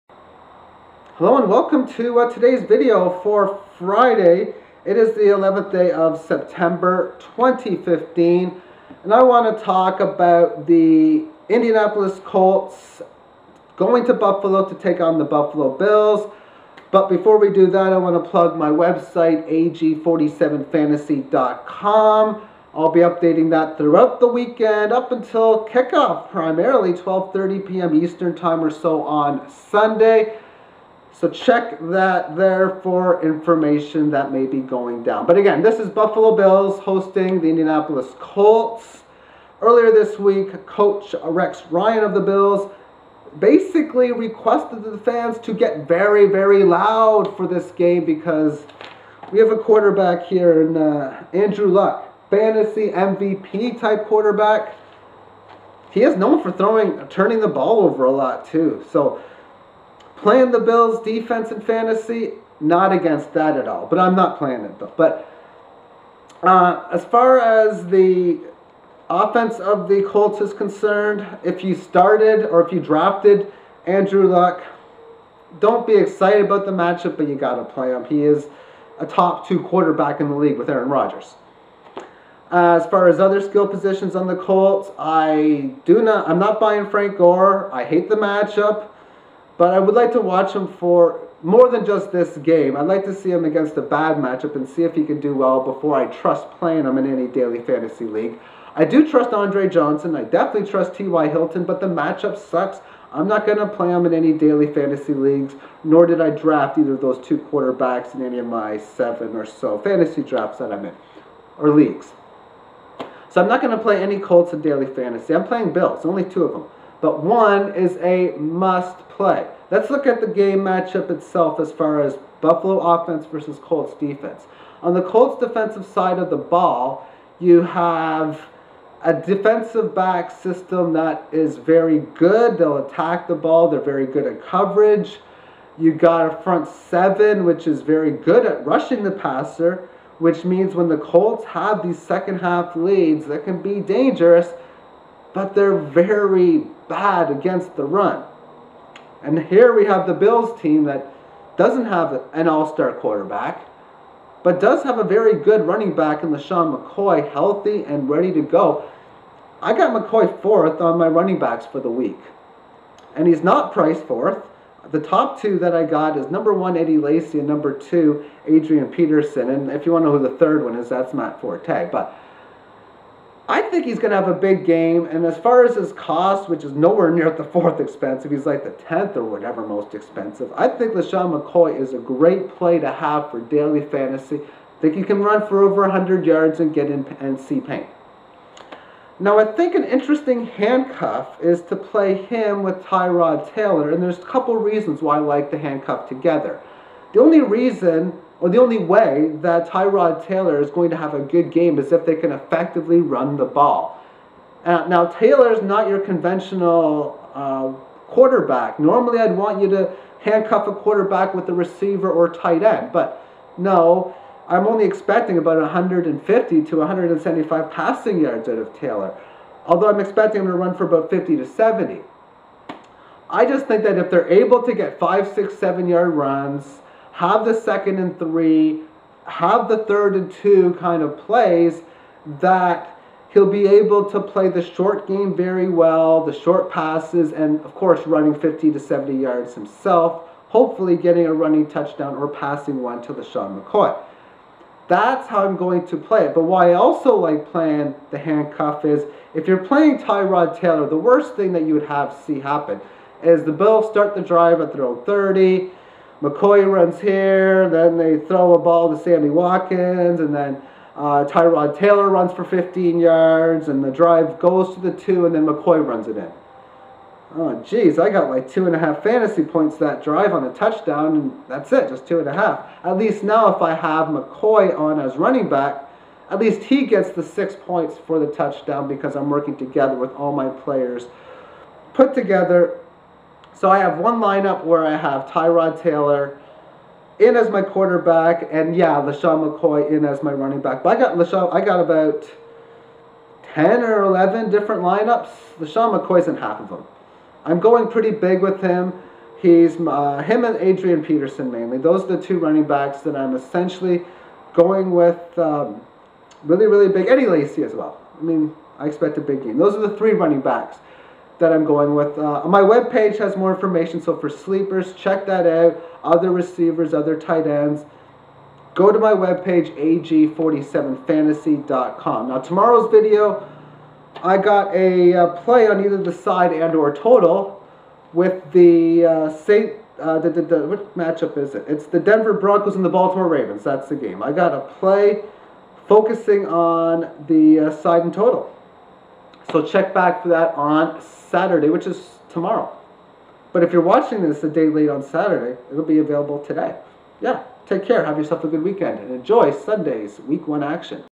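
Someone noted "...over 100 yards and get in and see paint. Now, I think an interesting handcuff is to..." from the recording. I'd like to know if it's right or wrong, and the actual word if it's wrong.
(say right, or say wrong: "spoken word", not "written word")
right.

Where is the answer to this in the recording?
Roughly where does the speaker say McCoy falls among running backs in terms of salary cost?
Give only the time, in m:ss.
2:58.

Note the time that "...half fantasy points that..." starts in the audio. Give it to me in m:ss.
4:28.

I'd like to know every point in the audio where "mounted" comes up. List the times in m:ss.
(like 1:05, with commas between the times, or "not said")
not said.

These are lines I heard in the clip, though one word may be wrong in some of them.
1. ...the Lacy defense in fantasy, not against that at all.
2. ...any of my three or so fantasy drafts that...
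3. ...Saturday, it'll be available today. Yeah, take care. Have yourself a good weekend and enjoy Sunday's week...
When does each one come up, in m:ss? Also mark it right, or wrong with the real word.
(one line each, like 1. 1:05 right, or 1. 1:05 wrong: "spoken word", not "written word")
1. 1:00 wrong: "Bills", not "Lacy"
2. 1:48 wrong: "seven", not "three"
3. 5:45 right.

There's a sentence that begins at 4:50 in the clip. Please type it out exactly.
But I got LeSean, I got about 10 or 11 different lineups.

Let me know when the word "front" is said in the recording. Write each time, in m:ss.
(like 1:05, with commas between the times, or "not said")
2:16.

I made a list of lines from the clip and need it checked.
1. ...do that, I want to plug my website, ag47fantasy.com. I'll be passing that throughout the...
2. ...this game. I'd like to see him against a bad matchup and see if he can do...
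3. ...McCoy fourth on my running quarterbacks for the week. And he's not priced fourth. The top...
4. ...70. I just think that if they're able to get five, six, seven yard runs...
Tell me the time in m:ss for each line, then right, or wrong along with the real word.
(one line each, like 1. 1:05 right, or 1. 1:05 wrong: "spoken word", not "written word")
1. 0:17 wrong: "updating", not "passing"
2. 1:32 right
3. 2:39 wrong: "backs", not "quarterbacks"
4. 3:41 right.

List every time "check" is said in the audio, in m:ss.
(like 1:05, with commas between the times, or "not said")
0:31, 5:14, 5:39.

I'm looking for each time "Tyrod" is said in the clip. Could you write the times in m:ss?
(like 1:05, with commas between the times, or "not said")
3:12, 3:19, 4:09, 4:21, 4:45.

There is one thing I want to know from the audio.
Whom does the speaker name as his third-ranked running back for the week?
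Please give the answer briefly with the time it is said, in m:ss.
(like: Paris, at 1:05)
Matt Forte, at 2:51.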